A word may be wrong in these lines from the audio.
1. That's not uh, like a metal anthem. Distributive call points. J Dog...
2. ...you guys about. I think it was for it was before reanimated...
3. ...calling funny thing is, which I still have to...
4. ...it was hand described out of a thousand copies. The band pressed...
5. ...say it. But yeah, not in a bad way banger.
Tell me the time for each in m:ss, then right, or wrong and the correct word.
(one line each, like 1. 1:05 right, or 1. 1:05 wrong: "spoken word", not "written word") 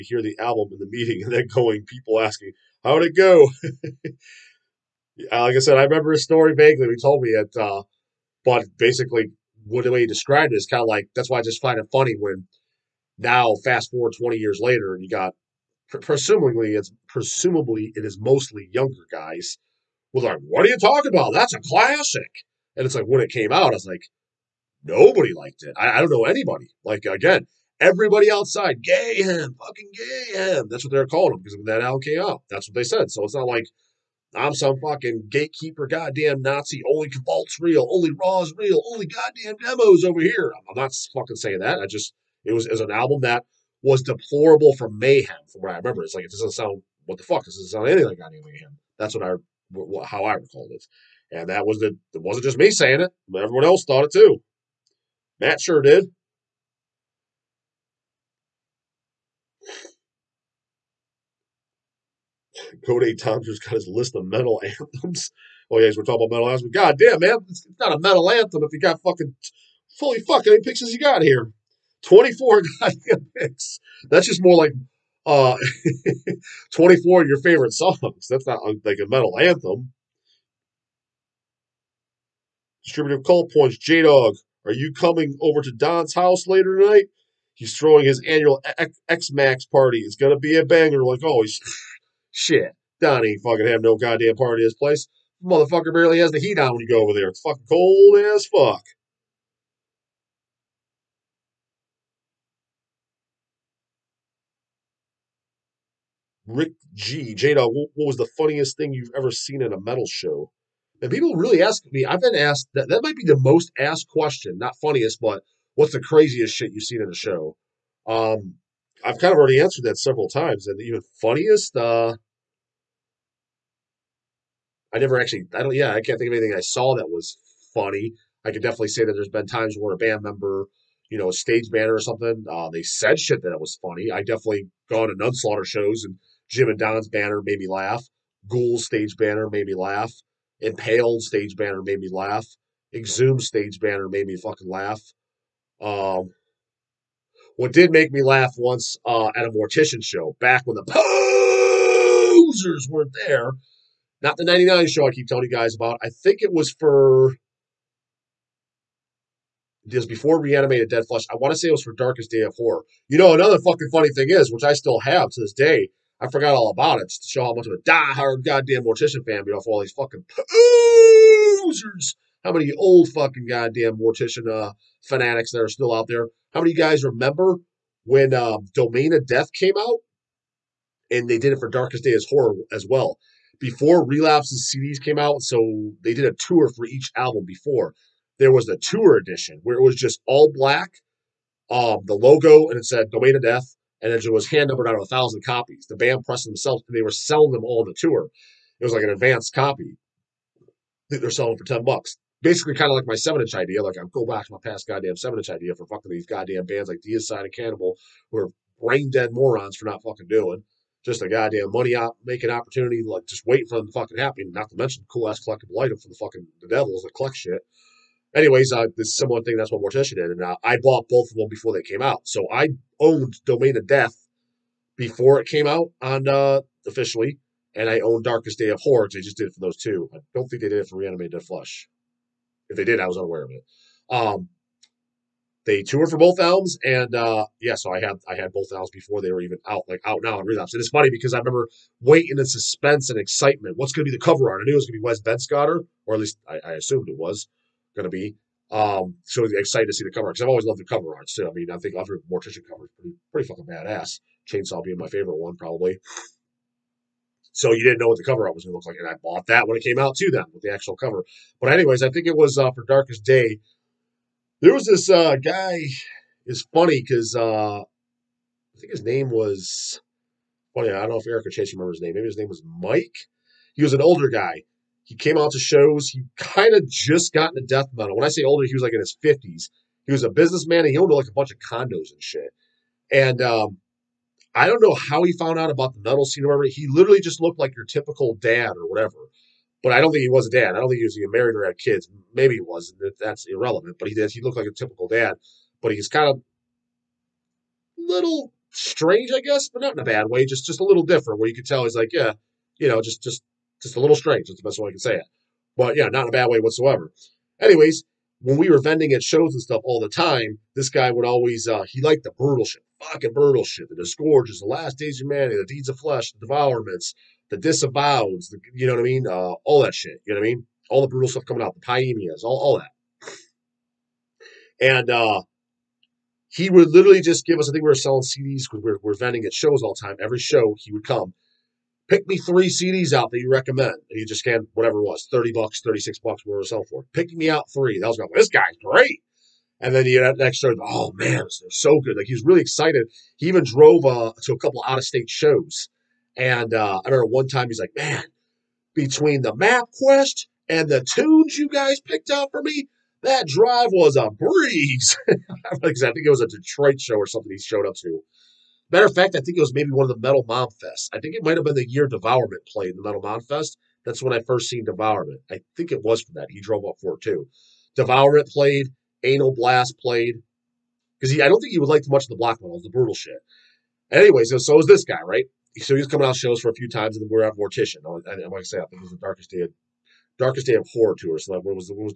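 1. 1:18 right
2. 2:35 right
3. 2:43 wrong: "fucking", not "calling"
4. 3:14 wrong: "numbered", not "described"
5. 5:04 wrong: "whatsoever", not "banger".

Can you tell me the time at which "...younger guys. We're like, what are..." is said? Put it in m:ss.
0:18.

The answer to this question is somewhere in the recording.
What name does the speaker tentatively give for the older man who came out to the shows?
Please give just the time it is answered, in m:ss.
4:32.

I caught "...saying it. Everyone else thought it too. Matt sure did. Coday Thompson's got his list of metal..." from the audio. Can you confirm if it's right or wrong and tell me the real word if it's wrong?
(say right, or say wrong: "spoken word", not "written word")
right.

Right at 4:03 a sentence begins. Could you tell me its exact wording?
What's going to be the cover art?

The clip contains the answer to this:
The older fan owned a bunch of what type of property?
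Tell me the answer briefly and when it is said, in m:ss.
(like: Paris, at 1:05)
Condos, at 4:41.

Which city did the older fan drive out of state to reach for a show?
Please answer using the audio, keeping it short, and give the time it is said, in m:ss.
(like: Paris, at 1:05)
Detroit, at 5:56.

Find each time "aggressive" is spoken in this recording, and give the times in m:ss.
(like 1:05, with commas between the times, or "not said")
not said.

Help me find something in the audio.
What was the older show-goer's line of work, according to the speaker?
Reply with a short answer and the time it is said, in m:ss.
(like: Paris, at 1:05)
Businessman, at 4:40.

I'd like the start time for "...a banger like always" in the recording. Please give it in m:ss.
1:30.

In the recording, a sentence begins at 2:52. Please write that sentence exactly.
How many old fucking goddamn mortician uh, fanatics that are still out there?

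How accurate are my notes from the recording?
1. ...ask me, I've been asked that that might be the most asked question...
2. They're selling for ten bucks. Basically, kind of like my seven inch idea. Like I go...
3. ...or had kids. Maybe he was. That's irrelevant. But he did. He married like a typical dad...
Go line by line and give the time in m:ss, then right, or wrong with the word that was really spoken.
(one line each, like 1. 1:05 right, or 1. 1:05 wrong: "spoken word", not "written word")
1. 1:51 right
2. 3:21 right
3. 4:51 wrong: "looked", not "married".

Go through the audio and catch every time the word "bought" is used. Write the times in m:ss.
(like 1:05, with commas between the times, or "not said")
3:40, 4:19.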